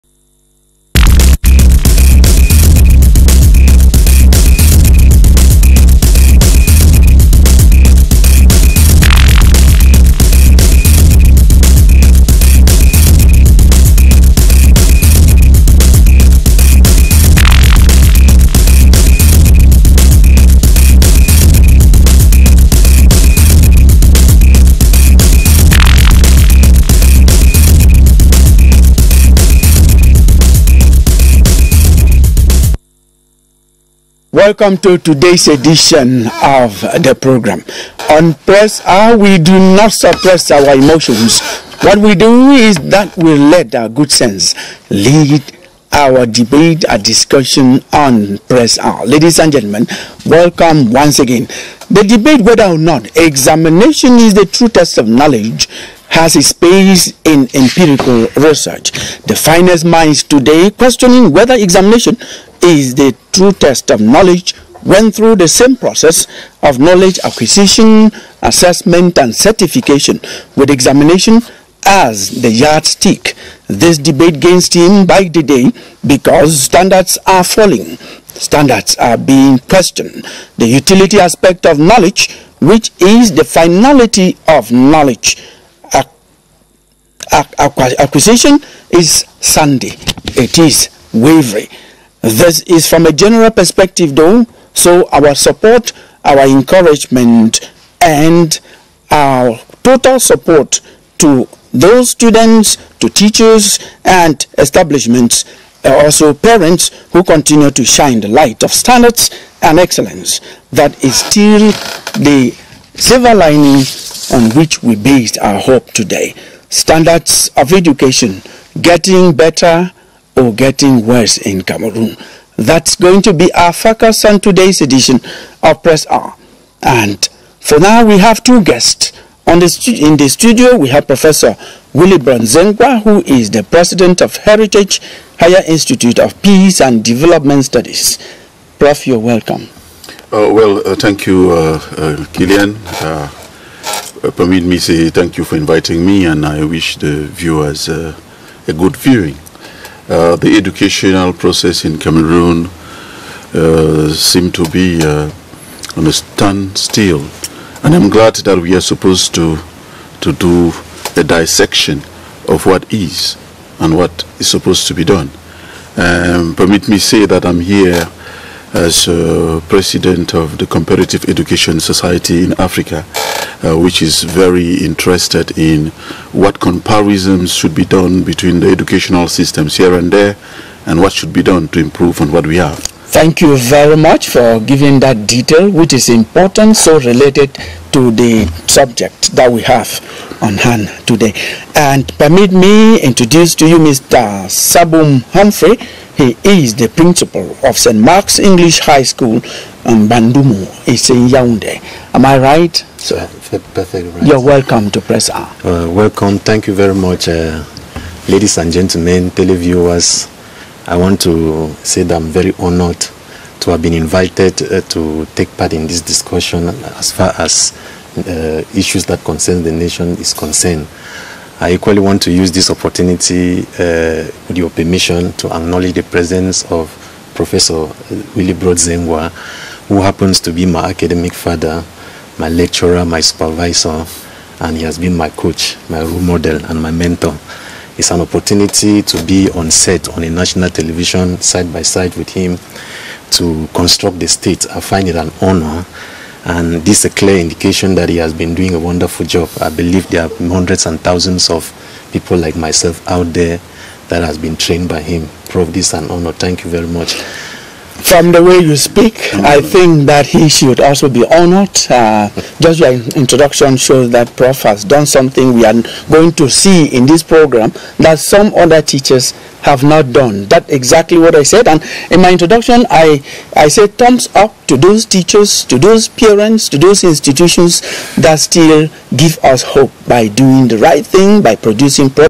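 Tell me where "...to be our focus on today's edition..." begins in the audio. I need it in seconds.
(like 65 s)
123 s.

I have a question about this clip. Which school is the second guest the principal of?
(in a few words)
St. Mark's English High School.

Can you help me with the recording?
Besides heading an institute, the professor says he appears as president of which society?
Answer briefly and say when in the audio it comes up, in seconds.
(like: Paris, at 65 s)
Comparative Education Society in Africa, at 170 s.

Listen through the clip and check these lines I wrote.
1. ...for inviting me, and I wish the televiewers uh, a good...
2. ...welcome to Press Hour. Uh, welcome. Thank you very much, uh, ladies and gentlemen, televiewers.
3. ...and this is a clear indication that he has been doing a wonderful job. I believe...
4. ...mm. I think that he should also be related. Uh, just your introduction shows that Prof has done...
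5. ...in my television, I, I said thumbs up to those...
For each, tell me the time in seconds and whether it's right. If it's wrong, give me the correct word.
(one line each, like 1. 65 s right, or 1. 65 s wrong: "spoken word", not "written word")
1. 145 s wrong: "viewers", not "televiewers"
2. 204 s right
3. 246 s right
4. 259 s wrong: "honored", not "related"
5. 272 s wrong: "introduction", not "television".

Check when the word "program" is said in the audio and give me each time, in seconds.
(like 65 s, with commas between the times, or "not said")
37 s, 267 s.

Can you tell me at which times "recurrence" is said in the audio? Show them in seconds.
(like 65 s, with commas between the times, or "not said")
not said.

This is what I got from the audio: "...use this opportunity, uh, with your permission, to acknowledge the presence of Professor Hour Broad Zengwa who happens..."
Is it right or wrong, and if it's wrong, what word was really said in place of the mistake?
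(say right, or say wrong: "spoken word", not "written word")
wrong: "Willy", not "Hour".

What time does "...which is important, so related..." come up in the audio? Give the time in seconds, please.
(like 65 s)
185 s.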